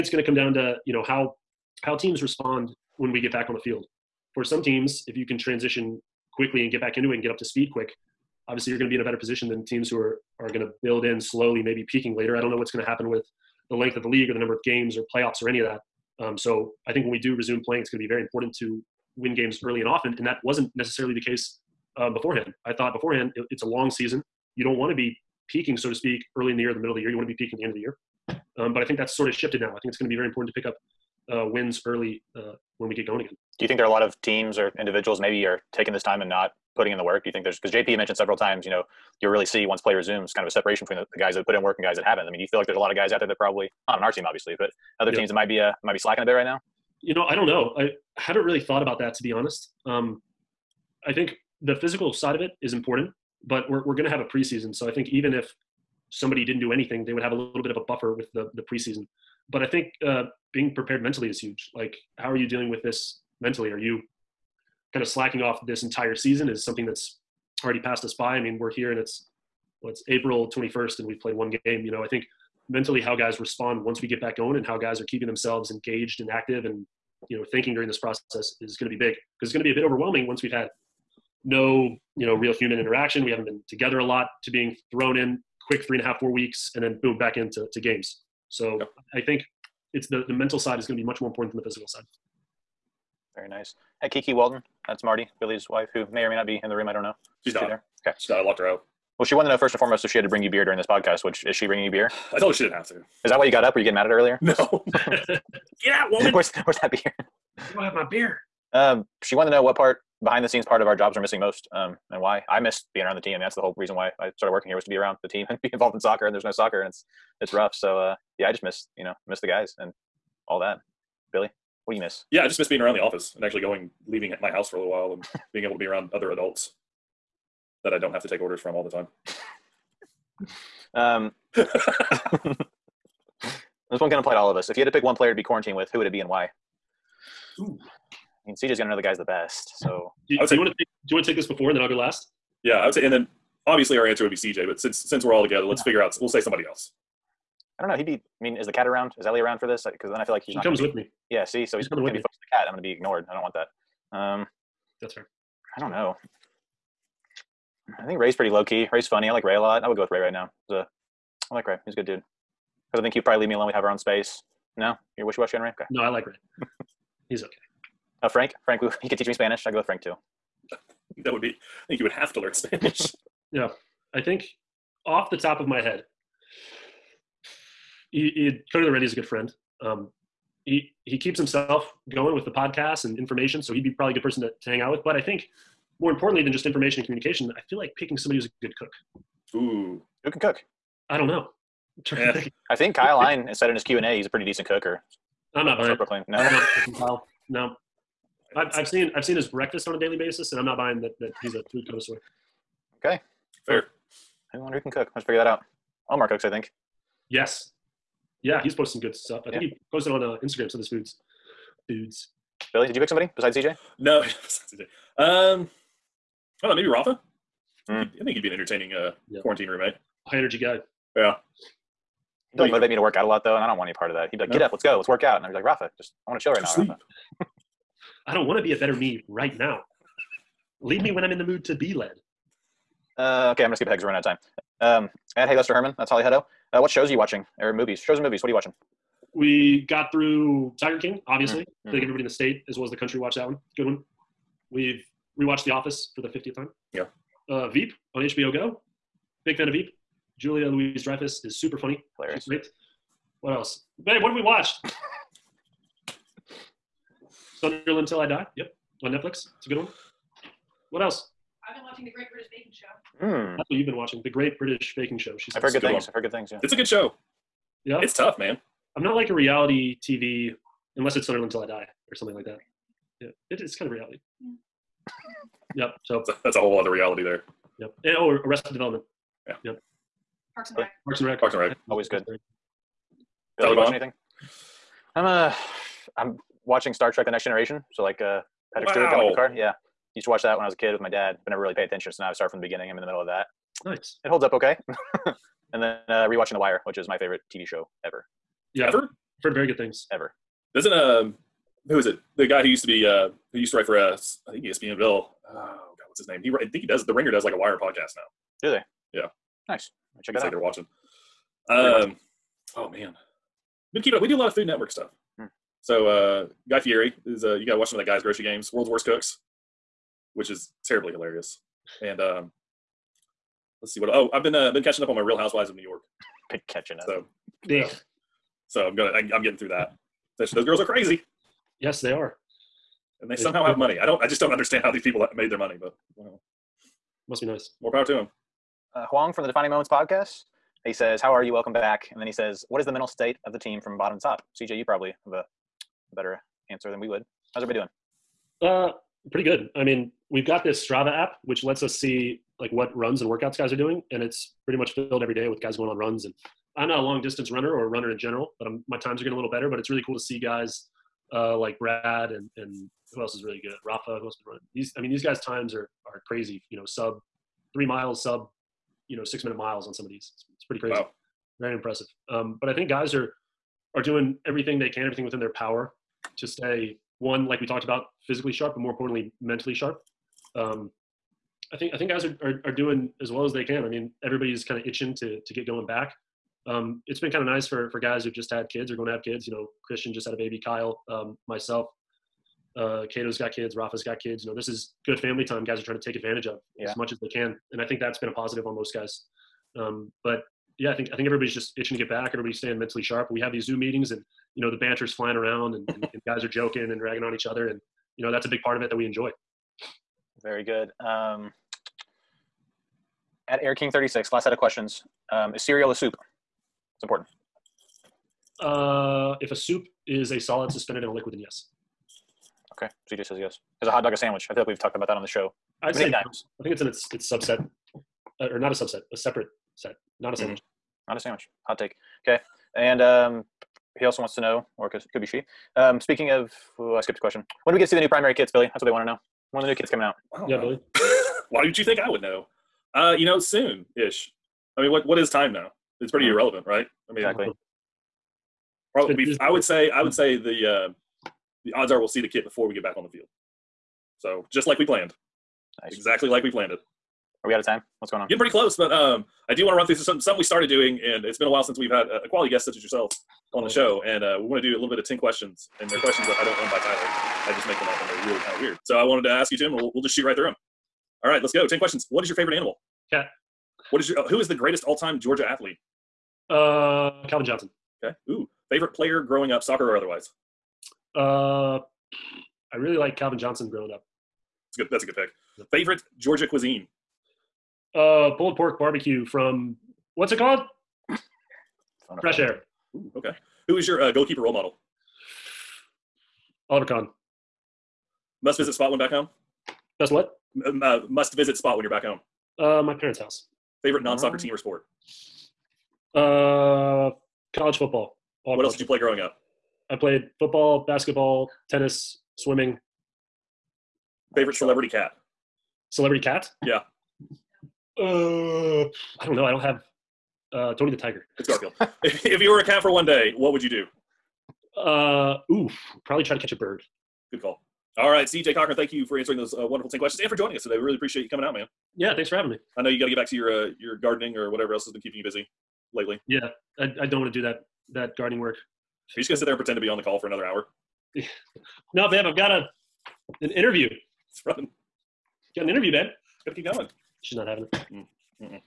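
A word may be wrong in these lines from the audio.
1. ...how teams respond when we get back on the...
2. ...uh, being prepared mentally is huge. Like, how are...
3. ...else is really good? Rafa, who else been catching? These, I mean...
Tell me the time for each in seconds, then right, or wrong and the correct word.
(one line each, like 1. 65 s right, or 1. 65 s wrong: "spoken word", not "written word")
1. 1 s right
2. 60 s right
3. 363 s wrong: "running", not "catching".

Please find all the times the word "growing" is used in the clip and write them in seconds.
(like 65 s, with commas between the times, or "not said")
479 s, 483 s, 508 s.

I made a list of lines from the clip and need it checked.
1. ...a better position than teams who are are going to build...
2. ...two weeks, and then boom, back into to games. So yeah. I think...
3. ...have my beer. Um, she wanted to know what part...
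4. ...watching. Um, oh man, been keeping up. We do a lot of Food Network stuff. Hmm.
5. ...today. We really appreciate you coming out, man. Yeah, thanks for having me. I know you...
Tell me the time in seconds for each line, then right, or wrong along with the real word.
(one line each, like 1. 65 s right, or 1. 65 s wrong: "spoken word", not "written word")
1. 9 s right
2. 86 s wrong: "four", not "two"
3. 107 s right
4. 310 s right
5. 530 s right.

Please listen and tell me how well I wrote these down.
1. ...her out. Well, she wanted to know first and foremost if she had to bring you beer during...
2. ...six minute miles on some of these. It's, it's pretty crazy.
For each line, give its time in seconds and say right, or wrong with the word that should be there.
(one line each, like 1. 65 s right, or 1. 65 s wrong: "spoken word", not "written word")
1. 98 s right
2. 369 s right.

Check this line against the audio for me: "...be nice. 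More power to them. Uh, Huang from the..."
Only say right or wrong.
right.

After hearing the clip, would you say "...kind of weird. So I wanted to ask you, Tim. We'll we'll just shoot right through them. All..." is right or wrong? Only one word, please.
right.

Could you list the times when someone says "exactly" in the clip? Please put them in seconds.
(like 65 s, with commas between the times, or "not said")
447 s, 455 s.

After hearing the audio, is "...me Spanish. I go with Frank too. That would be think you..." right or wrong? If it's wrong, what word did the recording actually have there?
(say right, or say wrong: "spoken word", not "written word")
right.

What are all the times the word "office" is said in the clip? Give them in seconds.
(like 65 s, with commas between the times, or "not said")
123 s, 245 s.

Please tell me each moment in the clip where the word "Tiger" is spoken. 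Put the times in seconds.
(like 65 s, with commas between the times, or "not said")
240 s, 520 s.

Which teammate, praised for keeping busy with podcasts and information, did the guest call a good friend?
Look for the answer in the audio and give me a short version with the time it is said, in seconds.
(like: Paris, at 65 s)
Cody Laurendi, at 178 s.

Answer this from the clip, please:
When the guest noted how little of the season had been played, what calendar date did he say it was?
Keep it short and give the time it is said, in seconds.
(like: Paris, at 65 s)
April 21st, at 70 s.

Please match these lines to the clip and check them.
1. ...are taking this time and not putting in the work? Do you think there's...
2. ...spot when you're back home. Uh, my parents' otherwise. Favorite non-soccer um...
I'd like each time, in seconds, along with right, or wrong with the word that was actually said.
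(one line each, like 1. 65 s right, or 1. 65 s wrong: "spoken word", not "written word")
1. 35 s right
2. 501 s wrong: "house", not "otherwise".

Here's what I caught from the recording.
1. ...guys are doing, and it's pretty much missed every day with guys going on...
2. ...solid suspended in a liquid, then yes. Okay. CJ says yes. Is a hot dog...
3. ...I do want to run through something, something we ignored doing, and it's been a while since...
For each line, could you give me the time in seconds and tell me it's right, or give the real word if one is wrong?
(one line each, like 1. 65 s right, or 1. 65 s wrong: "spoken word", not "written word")
1. 353 s wrong: "filled", not "missed"
2. 420 s right
3. 459 s wrong: "started", not "ignored".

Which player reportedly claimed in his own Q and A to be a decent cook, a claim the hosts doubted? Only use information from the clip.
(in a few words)
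Kyle Hyland.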